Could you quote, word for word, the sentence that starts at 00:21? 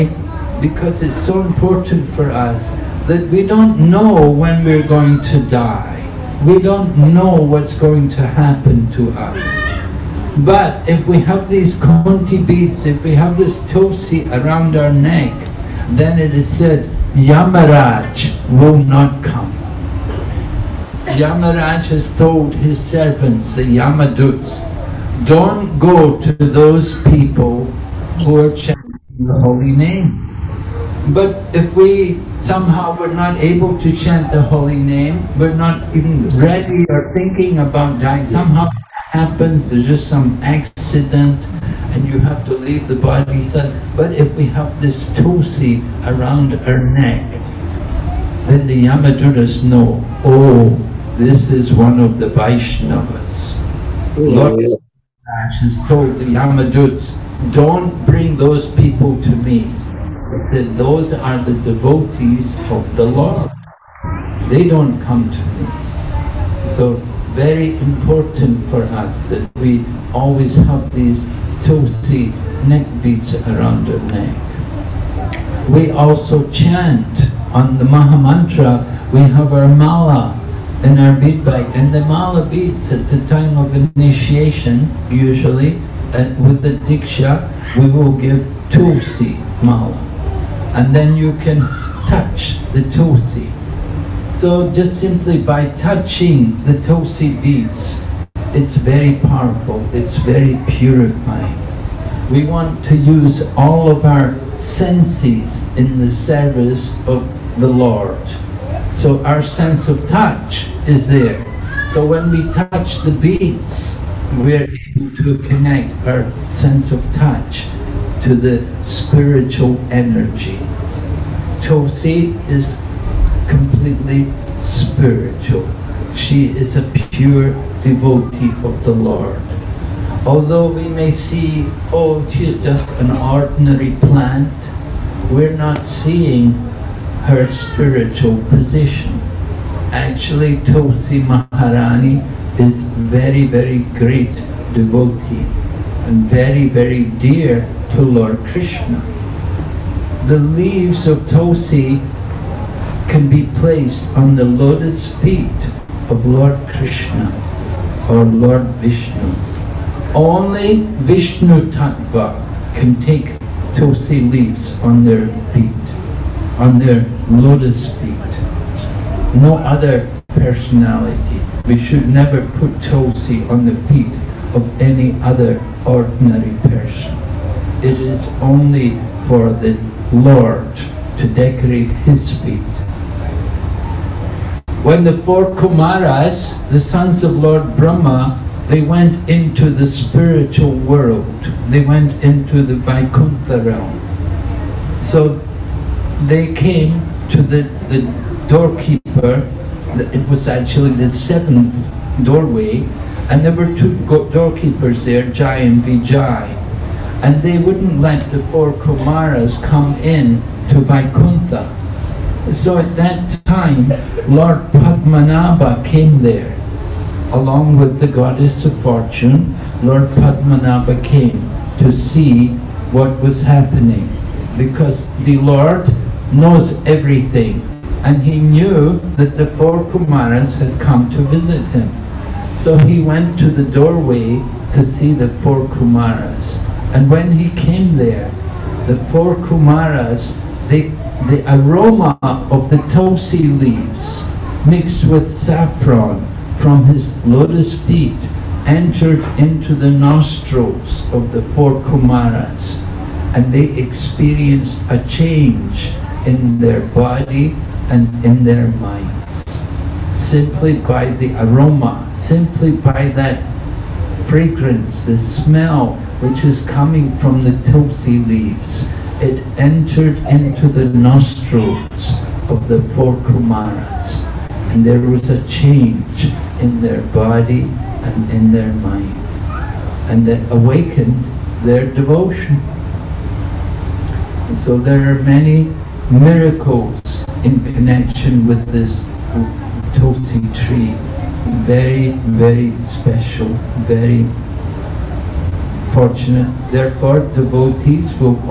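Yamaraj has told his servants, the Yamaduts, don't go to those people who are chanting the holy name.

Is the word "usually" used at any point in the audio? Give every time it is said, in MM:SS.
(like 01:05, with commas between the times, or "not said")
01:25.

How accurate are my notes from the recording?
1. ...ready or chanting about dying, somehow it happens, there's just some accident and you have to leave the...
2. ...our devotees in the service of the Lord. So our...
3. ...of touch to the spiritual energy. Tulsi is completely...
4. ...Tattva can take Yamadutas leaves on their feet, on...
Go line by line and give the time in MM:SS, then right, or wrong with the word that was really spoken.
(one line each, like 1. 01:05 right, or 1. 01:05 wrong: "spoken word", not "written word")
1. 00:36 wrong: "thinking", not "chanting"
2. 01:44 wrong: "senses", not "devotees"
3. 01:56 right
4. 02:41 wrong: "Tulsi", not "Yamadutas".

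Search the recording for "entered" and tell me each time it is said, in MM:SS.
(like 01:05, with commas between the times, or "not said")
04:08, 04:29.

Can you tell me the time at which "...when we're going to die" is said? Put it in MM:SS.
00:04.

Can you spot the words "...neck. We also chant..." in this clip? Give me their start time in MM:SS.
01:14.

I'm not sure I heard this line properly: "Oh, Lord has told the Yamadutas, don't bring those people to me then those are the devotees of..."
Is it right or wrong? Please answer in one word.
right.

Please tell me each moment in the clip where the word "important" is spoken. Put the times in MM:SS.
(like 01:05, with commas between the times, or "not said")
00:01, 01:07.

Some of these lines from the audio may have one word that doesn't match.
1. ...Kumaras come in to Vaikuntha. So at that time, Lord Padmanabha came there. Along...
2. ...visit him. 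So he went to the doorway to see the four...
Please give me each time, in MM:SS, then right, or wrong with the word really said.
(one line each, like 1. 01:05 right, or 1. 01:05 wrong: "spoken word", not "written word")
1. 03:28 right
2. 03:51 right.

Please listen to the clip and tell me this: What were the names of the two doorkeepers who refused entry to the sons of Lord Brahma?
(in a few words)
Jai and Vijay.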